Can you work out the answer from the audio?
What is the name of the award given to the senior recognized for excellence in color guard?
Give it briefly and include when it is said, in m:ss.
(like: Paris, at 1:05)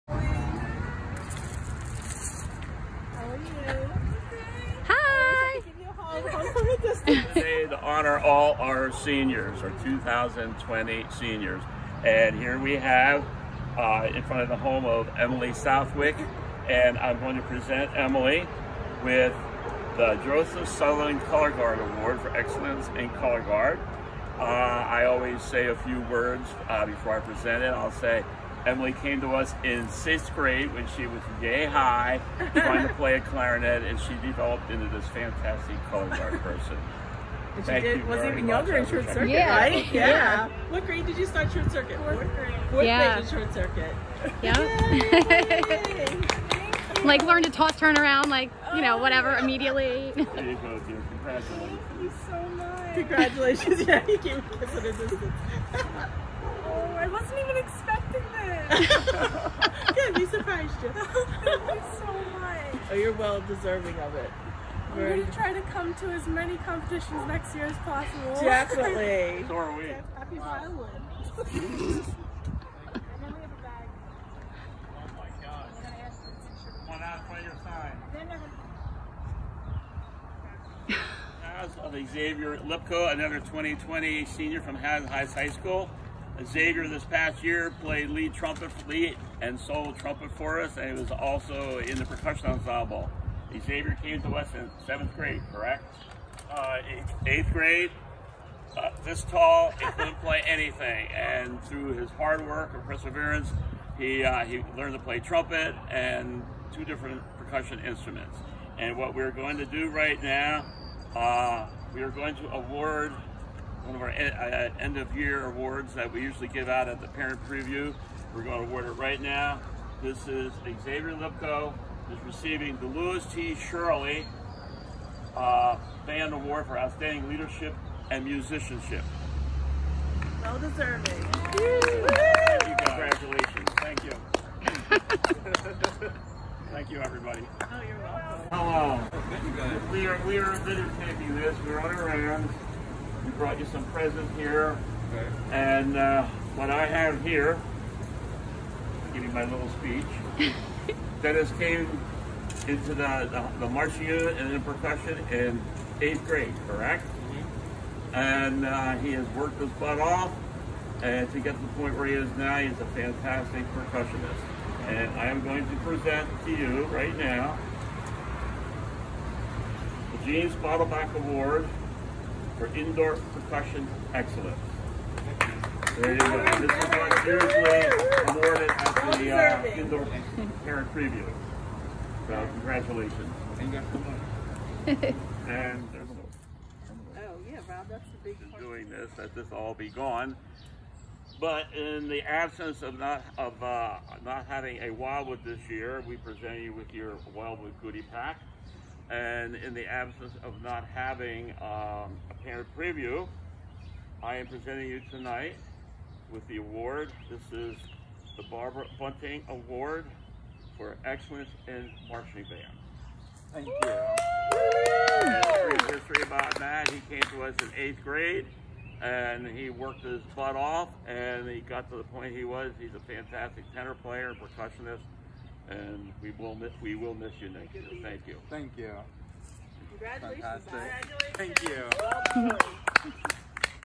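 Joseph Sutherland Color Guard Award, at 0:20.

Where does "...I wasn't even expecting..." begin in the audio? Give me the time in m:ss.
0:56.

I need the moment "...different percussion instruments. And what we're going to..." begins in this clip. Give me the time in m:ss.
1:46.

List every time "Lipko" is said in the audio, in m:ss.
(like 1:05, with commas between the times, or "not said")
1:22, 2:01.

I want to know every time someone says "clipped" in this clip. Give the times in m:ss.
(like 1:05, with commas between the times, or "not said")
not said.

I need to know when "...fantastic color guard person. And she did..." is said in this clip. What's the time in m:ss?
0:35.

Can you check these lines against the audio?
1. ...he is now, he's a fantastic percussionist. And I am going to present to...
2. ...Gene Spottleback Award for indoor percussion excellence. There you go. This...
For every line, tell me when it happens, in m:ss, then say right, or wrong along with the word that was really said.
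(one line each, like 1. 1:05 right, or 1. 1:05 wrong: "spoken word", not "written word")
1. 2:42 right
2. 2:50 right.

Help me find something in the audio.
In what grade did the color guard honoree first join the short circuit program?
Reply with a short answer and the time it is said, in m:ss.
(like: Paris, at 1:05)
Fourth grade, at 0:42.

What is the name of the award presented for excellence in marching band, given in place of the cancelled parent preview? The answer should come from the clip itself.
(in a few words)
Barbara Bunting Award.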